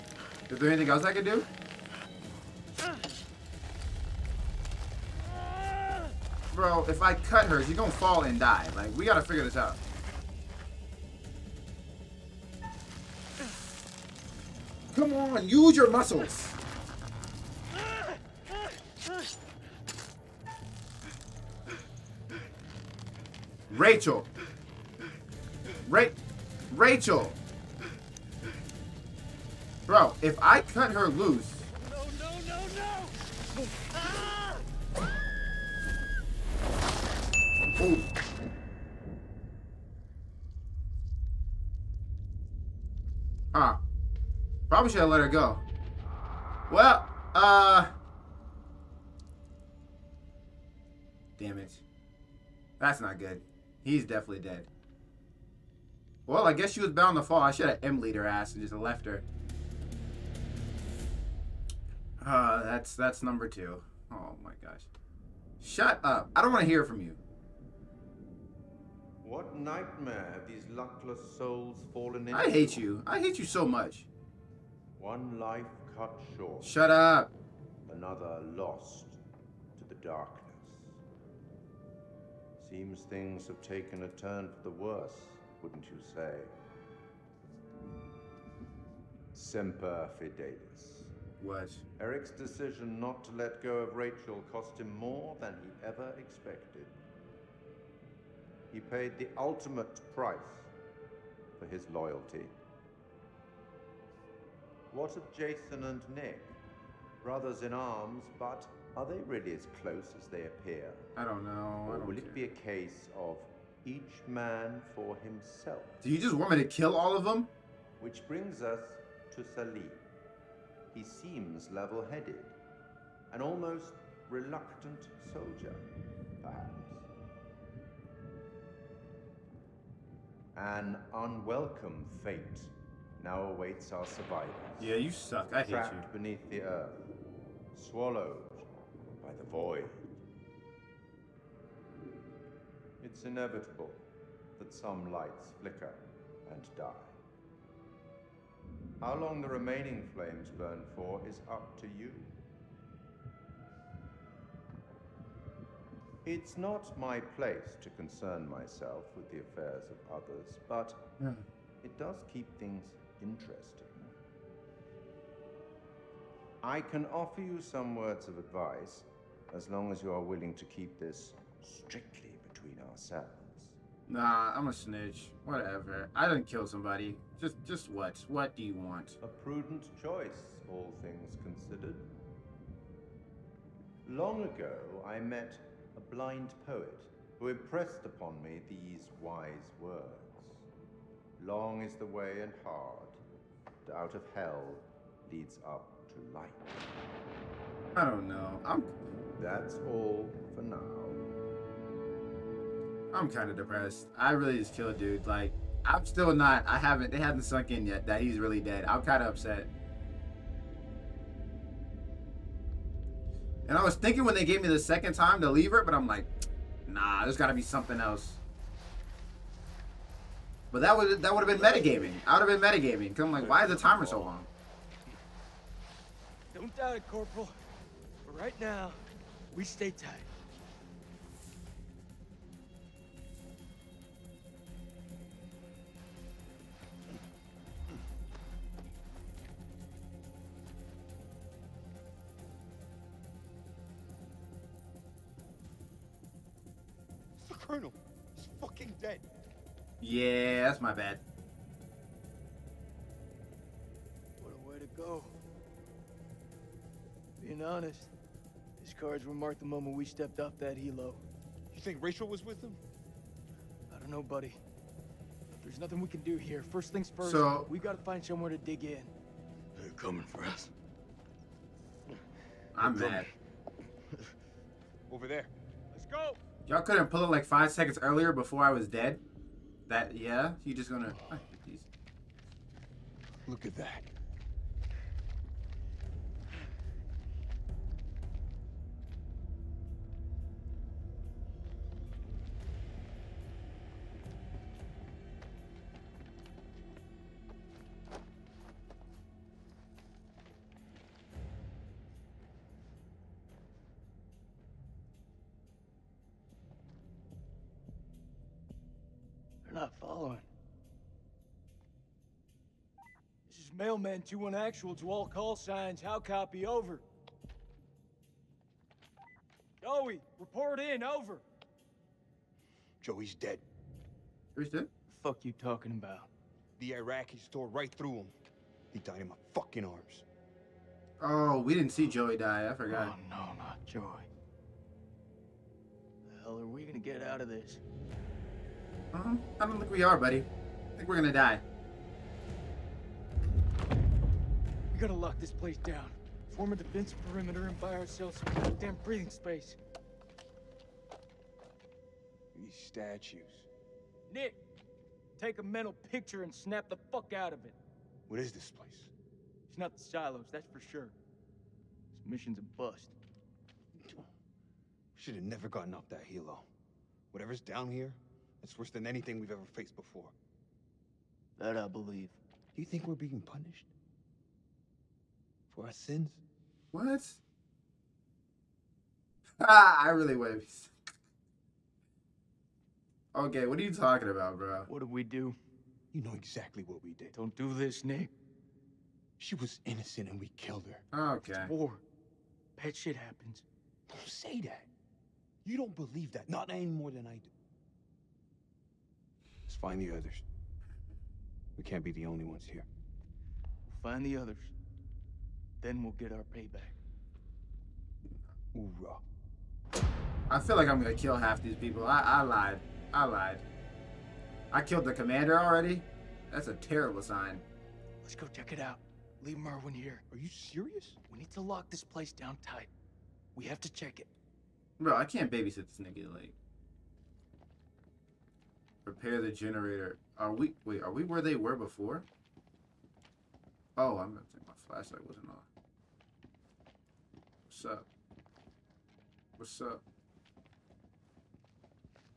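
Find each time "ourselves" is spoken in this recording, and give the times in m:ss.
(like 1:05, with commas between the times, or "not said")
2:52, 5:47.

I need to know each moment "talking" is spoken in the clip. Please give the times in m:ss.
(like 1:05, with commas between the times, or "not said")
5:25, 6:23.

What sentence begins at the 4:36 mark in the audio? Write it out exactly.
Y'all couldn't pull it like five seconds earlier before I was dead?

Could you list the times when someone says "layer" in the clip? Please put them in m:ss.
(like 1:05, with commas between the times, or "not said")
not said.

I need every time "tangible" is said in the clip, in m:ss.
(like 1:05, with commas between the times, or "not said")
not said.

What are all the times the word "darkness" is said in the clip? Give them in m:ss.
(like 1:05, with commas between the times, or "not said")
1:20.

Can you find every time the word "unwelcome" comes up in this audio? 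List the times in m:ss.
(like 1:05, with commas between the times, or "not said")
2:11.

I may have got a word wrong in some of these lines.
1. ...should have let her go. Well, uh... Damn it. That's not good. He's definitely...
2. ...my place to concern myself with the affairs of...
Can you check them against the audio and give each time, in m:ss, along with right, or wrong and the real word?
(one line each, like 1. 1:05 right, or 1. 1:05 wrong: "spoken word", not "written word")
1. 0:44 right
2. 2:36 right.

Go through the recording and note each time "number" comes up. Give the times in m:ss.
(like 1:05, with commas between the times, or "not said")
1:03.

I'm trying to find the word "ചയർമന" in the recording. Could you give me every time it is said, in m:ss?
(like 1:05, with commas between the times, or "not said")
not said.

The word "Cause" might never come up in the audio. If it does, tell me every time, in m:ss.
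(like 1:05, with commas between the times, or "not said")
3:43.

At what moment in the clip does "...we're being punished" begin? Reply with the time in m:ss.
6:13.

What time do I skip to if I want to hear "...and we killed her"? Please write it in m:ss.
6:30.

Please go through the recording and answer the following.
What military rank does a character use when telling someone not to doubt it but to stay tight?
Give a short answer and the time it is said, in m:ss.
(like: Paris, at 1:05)
Corporal, at 3:47.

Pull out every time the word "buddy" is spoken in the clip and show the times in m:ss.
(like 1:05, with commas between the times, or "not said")
4:24, 5:40.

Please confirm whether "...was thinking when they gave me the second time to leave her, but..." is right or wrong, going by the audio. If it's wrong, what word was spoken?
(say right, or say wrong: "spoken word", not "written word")
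right.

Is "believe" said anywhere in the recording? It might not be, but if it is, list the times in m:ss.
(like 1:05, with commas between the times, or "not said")
6:11, 6:35.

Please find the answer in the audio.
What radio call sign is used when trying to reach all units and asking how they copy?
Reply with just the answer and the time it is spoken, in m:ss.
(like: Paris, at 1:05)
Mailman 21 Actual, at 5:13.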